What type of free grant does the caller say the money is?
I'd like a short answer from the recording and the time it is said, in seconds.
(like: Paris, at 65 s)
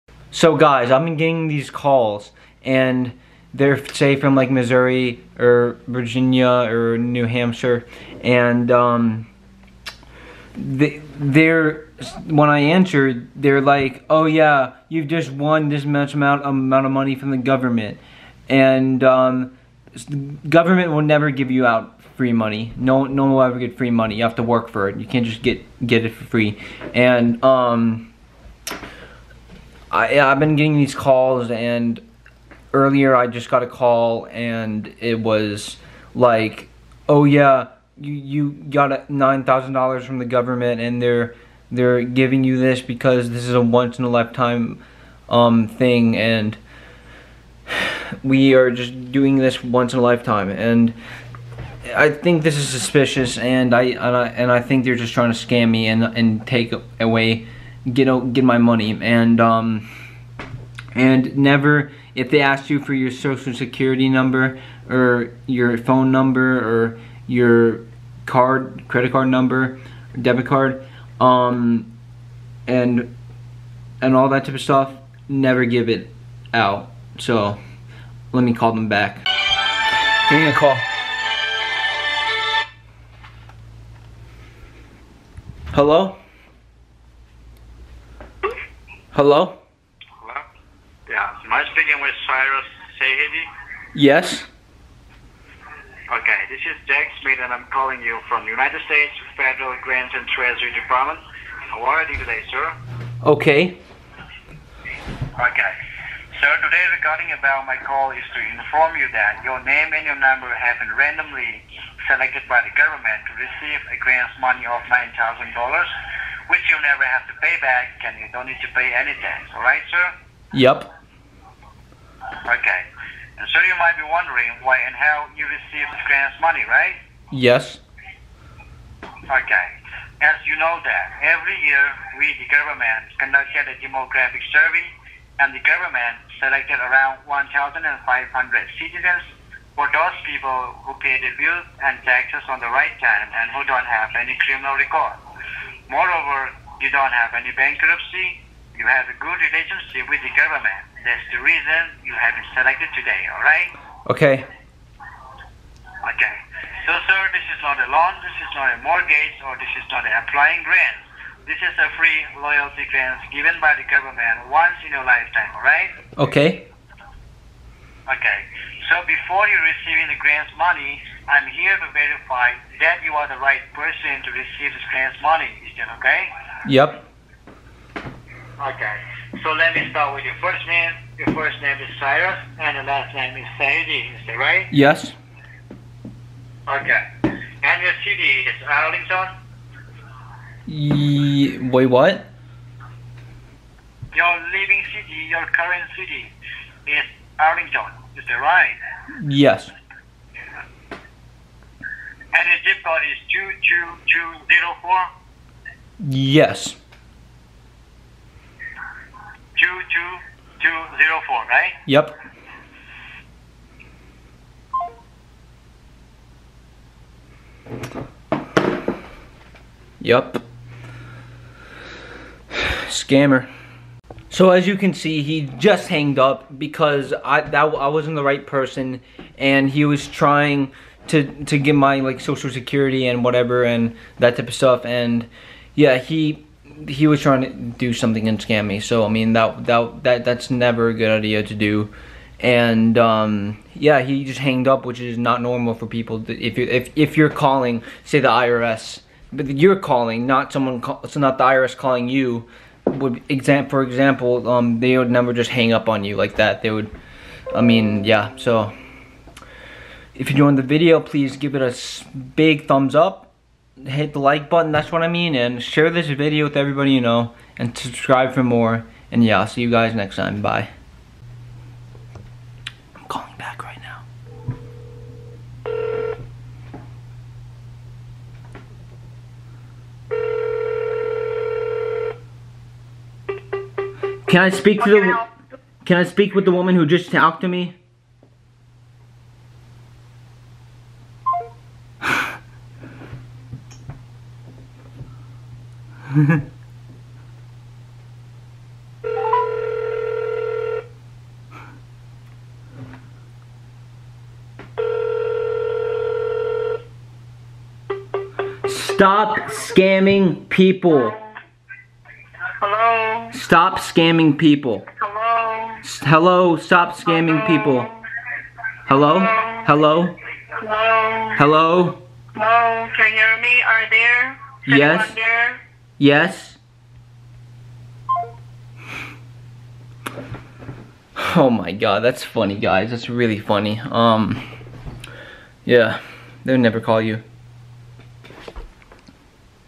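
loyalty grant, at 162 s.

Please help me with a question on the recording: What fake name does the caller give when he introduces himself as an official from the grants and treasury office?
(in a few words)
Jack Smith.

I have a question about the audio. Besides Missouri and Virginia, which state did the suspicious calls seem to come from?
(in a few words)
New Hampshire.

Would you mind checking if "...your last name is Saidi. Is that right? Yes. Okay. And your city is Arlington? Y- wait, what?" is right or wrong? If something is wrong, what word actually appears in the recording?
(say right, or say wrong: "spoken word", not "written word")
right.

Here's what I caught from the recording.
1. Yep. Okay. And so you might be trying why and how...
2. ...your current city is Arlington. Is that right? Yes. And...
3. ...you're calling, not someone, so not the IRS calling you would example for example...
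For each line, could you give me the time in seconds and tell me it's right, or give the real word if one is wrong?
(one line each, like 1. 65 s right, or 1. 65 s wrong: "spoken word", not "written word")
1. 120 s wrong: "wondering", not "trying"
2. 195 s right
3. 249 s right.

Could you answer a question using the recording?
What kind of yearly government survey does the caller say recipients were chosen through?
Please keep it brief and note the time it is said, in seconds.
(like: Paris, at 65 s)
demographic survey, at 133 s.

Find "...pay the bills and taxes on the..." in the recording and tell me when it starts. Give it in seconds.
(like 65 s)
140 s.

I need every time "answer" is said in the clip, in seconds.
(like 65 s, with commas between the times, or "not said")
12 s.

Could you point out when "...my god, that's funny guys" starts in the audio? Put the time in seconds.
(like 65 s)
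331 s.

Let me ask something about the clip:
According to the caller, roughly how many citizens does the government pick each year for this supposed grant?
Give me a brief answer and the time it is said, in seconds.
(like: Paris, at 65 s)
1,500, at 137 s.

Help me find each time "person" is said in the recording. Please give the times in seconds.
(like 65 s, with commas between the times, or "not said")
173 s, 228 s.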